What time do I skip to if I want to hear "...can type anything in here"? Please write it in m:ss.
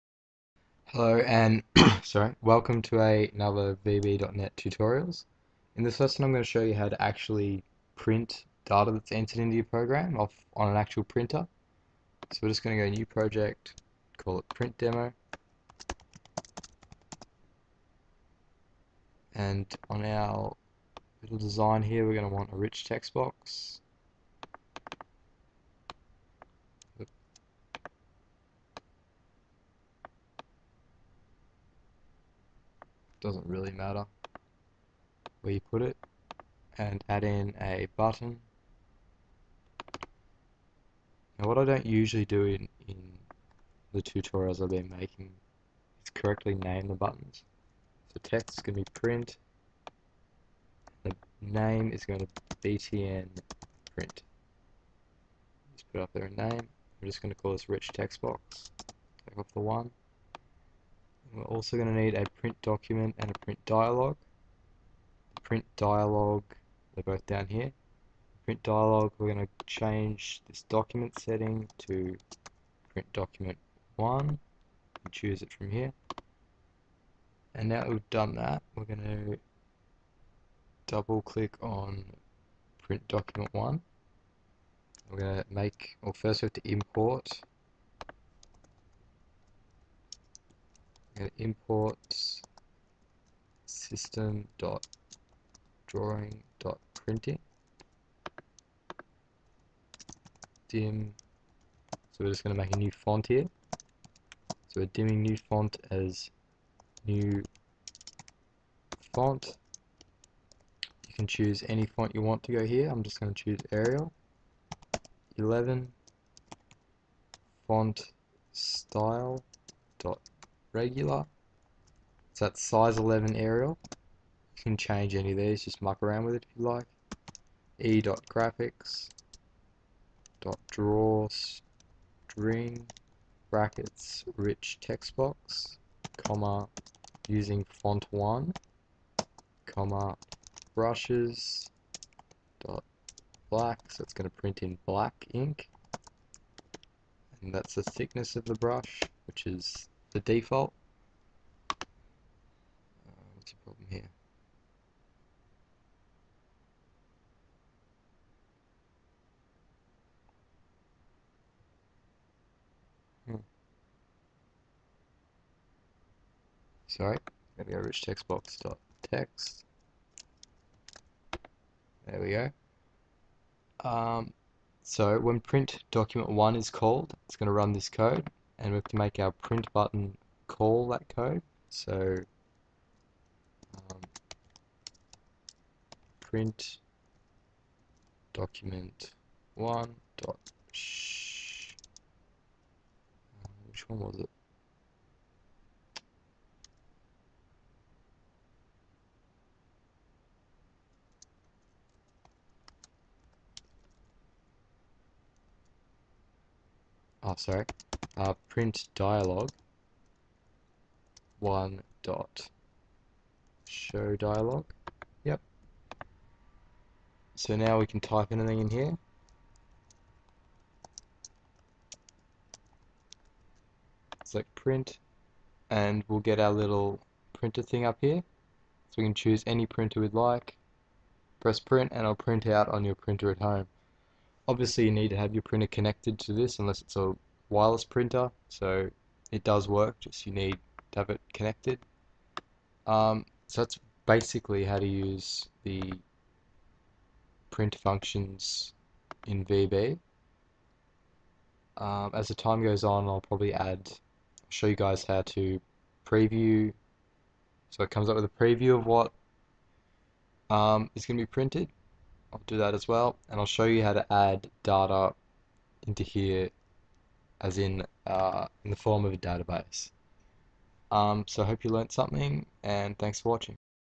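3:37.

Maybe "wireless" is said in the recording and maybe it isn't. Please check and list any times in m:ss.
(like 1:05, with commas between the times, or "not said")
3:57.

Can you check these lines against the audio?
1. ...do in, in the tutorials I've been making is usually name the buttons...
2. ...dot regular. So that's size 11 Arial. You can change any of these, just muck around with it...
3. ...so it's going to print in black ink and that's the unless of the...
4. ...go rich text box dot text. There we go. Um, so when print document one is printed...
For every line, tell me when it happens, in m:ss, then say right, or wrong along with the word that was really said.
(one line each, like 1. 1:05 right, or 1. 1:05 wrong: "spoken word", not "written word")
1. 0:42 wrong: "correctly", not "usually"
2. 1:59 right
3. 2:23 wrong: "thickness", not "unless"
4. 2:47 wrong: "called", not "printed".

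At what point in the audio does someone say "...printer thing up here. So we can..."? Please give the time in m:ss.
3:47.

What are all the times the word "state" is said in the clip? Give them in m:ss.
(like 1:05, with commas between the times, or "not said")
not said.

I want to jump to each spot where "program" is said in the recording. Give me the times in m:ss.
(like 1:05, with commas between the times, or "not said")
0:09.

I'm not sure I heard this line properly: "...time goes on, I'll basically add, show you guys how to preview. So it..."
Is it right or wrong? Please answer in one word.
wrong.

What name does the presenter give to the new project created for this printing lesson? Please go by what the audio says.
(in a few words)
print demo.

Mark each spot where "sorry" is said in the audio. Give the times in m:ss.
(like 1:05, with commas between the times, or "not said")
0:02, 2:46, 3:27.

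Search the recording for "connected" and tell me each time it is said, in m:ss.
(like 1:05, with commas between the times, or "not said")
3:55, 4:01.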